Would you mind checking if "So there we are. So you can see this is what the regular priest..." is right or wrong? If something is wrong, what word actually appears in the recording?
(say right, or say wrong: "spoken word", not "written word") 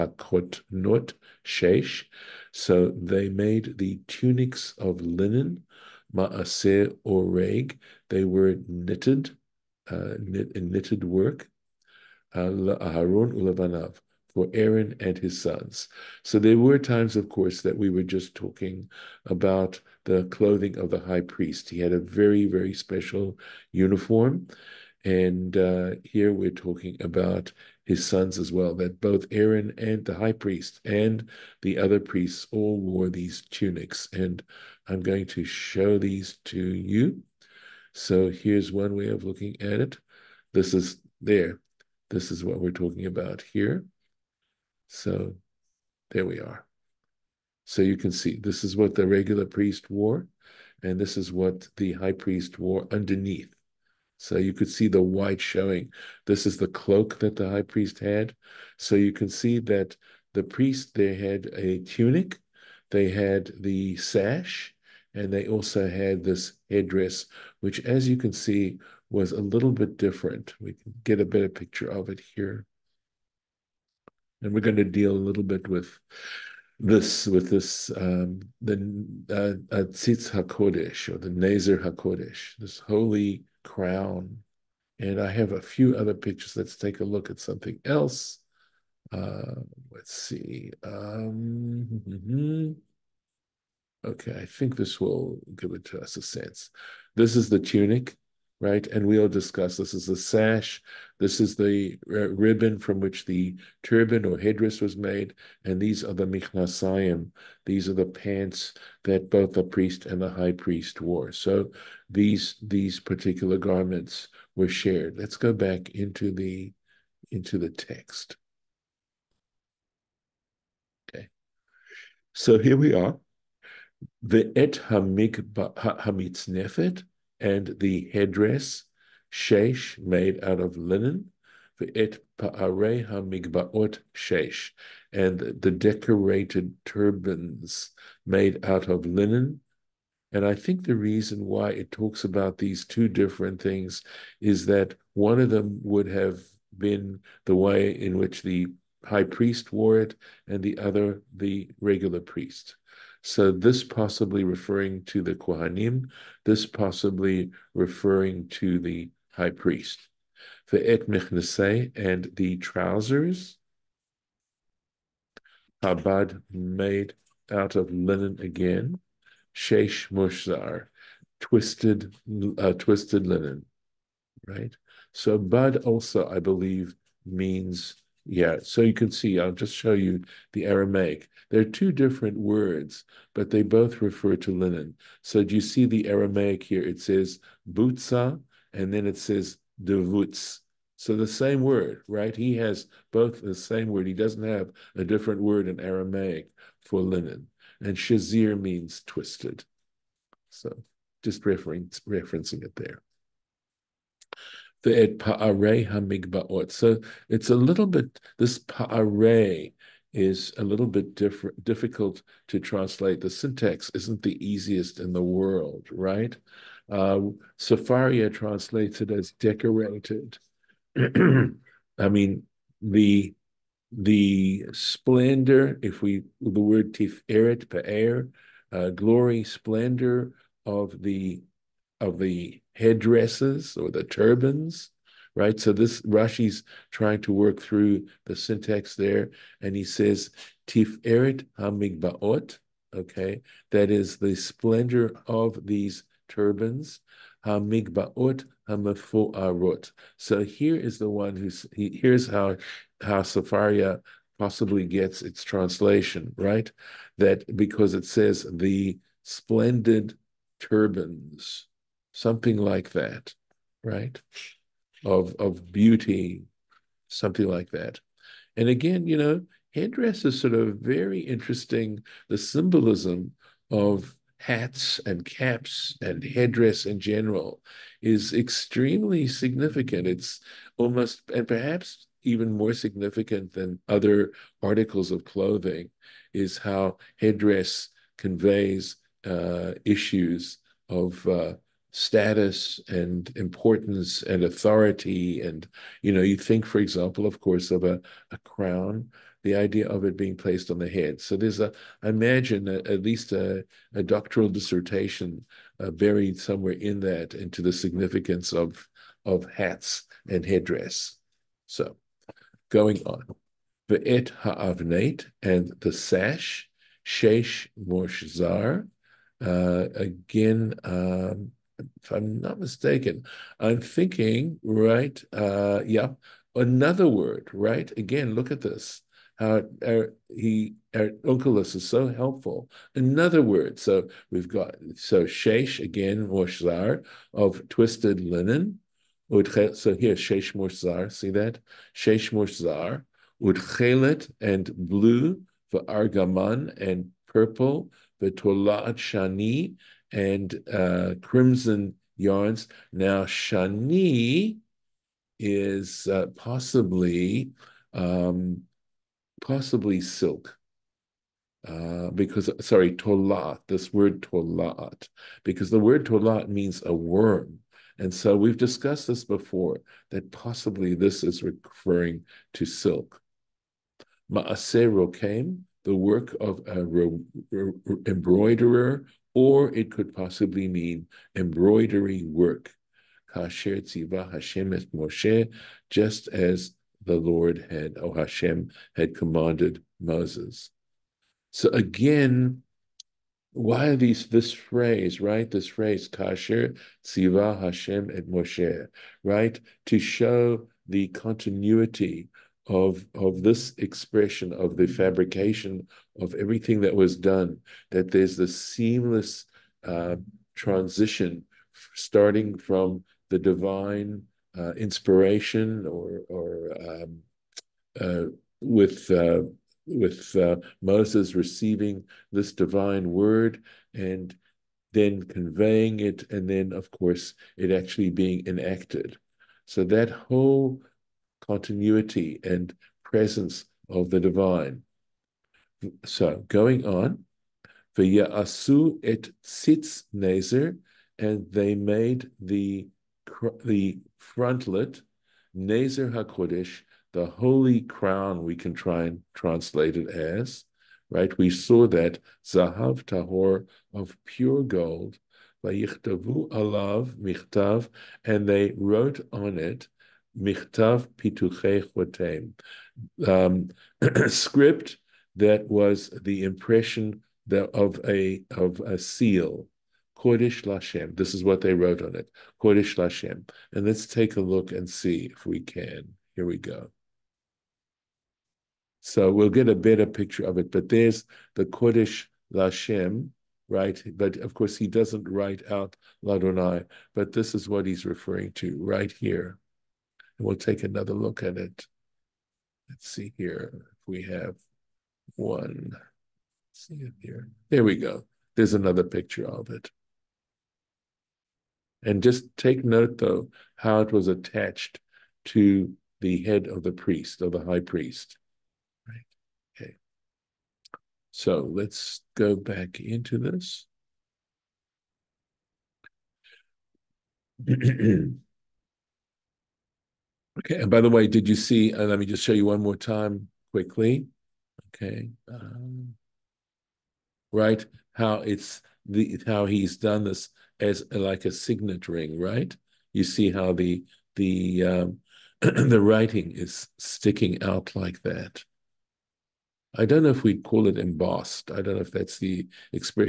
right.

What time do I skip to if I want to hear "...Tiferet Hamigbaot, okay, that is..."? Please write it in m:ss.
4:00.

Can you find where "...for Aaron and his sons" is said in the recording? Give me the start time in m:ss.
0:14.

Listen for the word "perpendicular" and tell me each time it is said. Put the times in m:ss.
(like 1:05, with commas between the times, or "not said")
not said.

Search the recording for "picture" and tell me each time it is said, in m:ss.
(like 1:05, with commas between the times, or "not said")
1:11, 1:26, 8:00, 8:19.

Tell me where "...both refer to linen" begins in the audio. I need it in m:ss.
3:03.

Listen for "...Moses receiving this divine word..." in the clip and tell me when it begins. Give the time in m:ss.
7:00.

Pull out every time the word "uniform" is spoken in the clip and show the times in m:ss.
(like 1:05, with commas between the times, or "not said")
0:23.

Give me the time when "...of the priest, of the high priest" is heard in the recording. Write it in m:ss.
8:26.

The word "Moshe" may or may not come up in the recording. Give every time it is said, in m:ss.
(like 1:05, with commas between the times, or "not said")
6:24, 6:38.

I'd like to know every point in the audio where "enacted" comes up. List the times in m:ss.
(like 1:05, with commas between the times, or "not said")
7:08.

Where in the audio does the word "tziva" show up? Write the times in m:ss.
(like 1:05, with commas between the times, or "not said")
6:23, 6:37.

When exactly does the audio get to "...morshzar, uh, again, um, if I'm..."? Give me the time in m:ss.
5:17.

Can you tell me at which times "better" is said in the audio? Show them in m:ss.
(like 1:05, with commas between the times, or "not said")
1:11, 7:59.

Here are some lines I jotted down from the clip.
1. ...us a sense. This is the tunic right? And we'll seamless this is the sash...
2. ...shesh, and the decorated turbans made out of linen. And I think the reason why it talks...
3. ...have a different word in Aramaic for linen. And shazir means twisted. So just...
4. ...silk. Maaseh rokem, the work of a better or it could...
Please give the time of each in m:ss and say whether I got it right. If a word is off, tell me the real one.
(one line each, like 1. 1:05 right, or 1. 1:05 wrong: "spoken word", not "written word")
1. 1:36 wrong: "discuss", not "seamless"
2. 2:14 right
3. 3:14 right
4. 6:12 wrong: "embroiderer", not "better".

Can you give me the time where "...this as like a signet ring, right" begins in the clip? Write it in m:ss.
8:50.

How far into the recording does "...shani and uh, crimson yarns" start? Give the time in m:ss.
5:48.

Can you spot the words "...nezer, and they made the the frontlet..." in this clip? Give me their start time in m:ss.
7:20.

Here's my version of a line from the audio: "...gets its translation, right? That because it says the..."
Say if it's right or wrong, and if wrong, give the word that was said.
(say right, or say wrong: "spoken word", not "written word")
right.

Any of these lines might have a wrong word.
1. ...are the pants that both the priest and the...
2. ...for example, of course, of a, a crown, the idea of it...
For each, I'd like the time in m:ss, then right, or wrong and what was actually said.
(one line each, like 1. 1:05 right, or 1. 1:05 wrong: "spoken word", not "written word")
1. 1:47 right
2. 4:56 right.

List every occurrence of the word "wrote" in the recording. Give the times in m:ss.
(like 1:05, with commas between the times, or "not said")
7:38, 7:51.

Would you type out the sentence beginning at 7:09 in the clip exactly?
So that whole continuity and presence of the divine.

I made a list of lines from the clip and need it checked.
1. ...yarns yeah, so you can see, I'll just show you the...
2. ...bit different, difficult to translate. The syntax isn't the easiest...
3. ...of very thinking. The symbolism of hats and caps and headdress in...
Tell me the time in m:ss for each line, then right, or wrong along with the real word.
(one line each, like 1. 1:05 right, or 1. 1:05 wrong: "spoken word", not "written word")
1. 2:57 wrong: "means", not "yarns"
2. 3:30 right
3. 4:30 wrong: "interesting", not "thinking".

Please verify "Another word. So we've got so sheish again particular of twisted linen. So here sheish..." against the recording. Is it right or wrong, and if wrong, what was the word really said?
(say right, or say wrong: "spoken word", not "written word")
wrong: "morsar", not "particular".